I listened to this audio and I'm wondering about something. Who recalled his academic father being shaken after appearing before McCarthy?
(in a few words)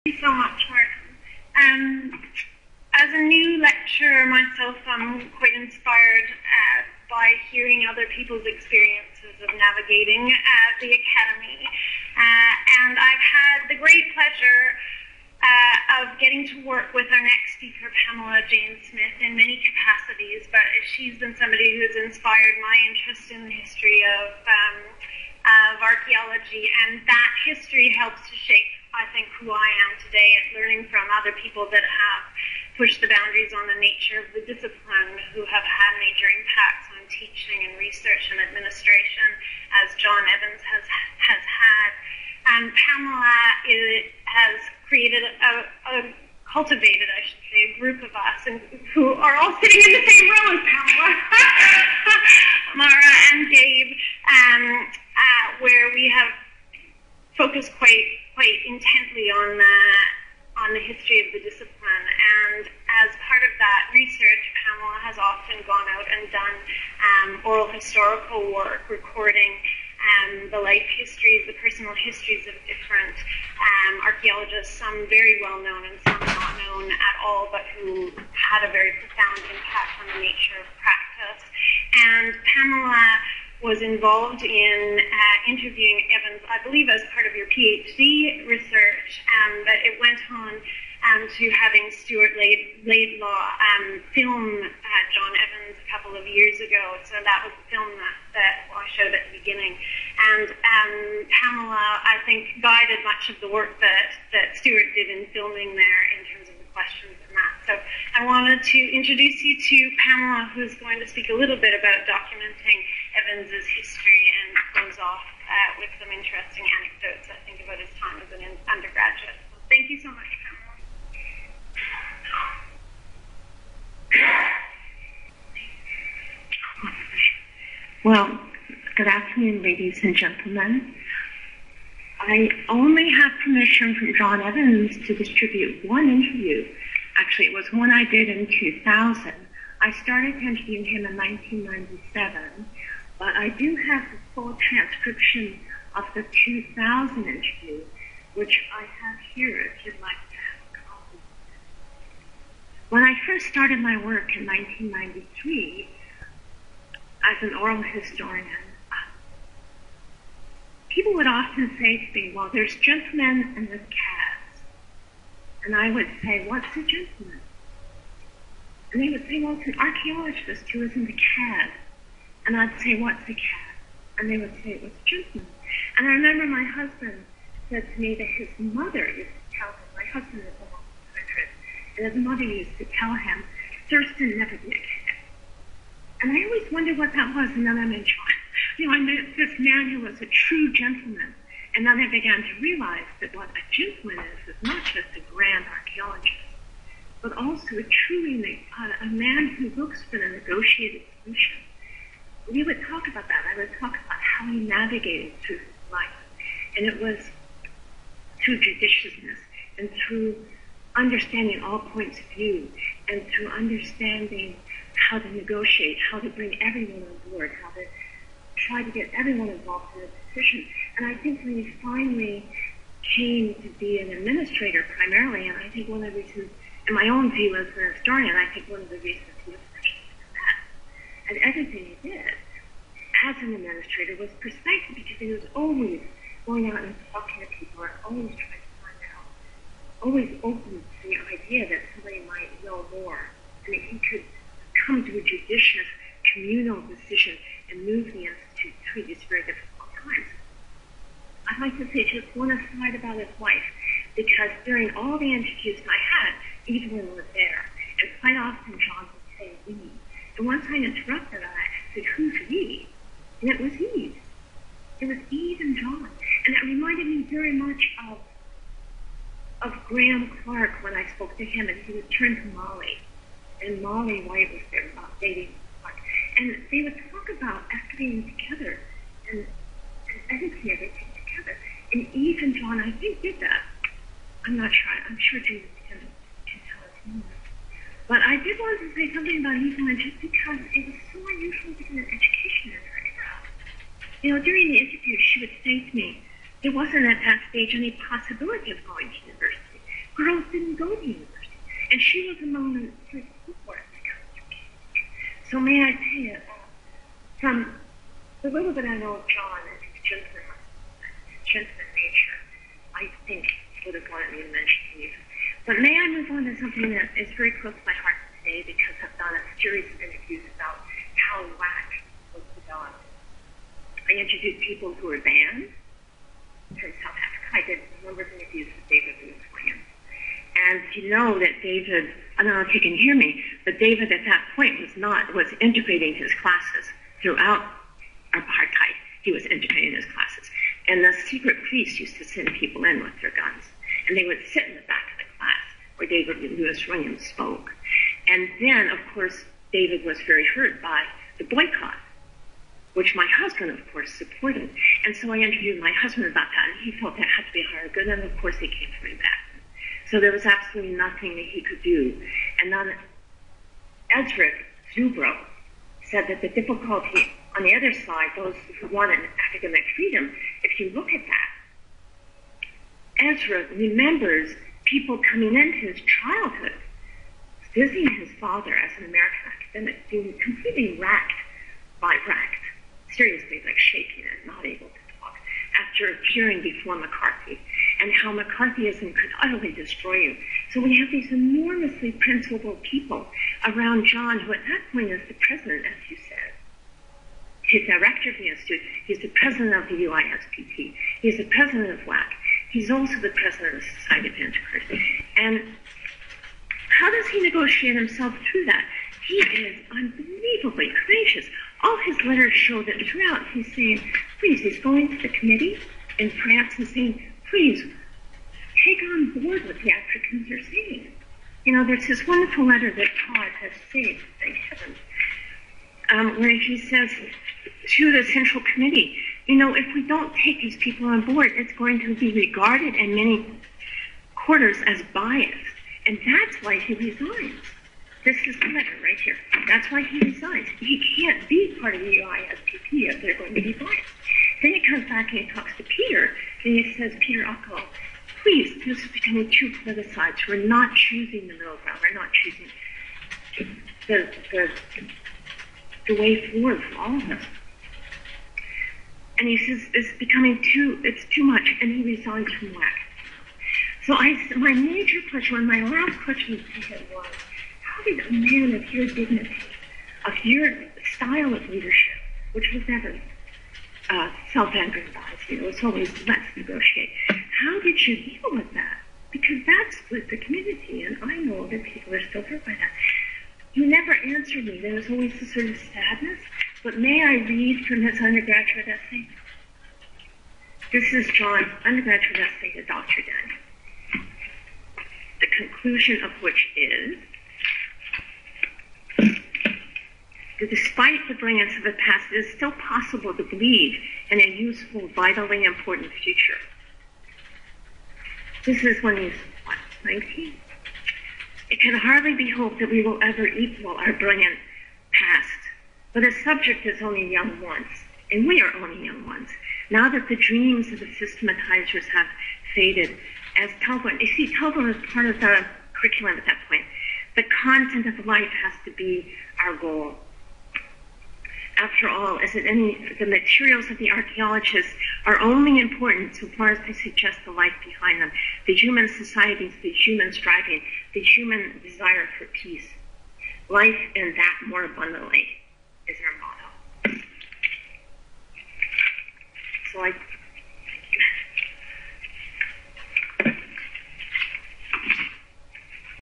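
Ezra Zubrow.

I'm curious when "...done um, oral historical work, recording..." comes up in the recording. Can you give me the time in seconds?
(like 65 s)
66 s.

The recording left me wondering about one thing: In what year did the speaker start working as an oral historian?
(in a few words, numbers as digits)
1993.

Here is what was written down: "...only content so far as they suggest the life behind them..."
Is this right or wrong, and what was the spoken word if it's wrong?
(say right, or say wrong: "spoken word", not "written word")
wrong: "important", not "content".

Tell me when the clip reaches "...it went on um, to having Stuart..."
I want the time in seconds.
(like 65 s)
89 s.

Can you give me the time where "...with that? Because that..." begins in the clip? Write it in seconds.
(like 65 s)
478 s.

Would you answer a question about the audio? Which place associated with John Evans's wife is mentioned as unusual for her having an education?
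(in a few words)
Newfoundland.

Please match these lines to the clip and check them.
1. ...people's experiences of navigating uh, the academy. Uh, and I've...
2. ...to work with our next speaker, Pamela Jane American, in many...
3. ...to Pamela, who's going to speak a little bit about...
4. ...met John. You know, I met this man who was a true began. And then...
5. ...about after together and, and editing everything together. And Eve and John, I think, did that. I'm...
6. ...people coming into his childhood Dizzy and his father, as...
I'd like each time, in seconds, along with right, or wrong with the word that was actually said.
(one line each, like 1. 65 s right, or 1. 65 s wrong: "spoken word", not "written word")
1. 8 s right
2. 16 s wrong: "Smith", not "American"
3. 109 s right
4. 187 s wrong: "gentleman", not "began"
5. 277 s right
6. 374 s right.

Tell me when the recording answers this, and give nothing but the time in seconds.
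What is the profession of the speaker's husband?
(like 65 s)
181 s.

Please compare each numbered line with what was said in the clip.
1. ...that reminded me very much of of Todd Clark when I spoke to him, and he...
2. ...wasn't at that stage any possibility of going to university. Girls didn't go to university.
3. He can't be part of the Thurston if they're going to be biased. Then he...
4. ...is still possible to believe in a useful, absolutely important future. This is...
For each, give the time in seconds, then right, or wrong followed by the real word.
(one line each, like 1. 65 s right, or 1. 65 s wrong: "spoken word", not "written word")
1. 266 s wrong: "Grahame", not "Todd"
2. 296 s right
3. 440 s wrong: "UISPP", not "Thurston"
4. 502 s wrong: "vitally", not "absolutely".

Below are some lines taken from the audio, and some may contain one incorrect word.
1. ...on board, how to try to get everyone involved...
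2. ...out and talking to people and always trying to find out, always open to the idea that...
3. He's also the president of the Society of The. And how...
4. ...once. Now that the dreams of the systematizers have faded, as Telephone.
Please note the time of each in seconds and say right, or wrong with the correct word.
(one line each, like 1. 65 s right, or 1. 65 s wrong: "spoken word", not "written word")
1. 217 s right
2. 236 s right
3. 402 s wrong: "Antiquaries", not "The"
4. 519 s right.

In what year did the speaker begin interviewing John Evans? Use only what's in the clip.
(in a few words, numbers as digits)
1997.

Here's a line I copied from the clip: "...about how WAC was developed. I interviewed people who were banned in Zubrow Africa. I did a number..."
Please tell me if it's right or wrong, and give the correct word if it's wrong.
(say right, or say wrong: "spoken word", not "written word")
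wrong: "South", not "Zubrow".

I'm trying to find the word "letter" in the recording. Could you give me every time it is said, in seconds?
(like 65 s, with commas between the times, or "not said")
412 s, 422 s, 438 s.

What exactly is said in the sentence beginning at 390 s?
So we have these enormously principled people around John, who at that point is the president, as you said.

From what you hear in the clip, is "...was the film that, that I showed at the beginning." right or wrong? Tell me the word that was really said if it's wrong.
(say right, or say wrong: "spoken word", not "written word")
right.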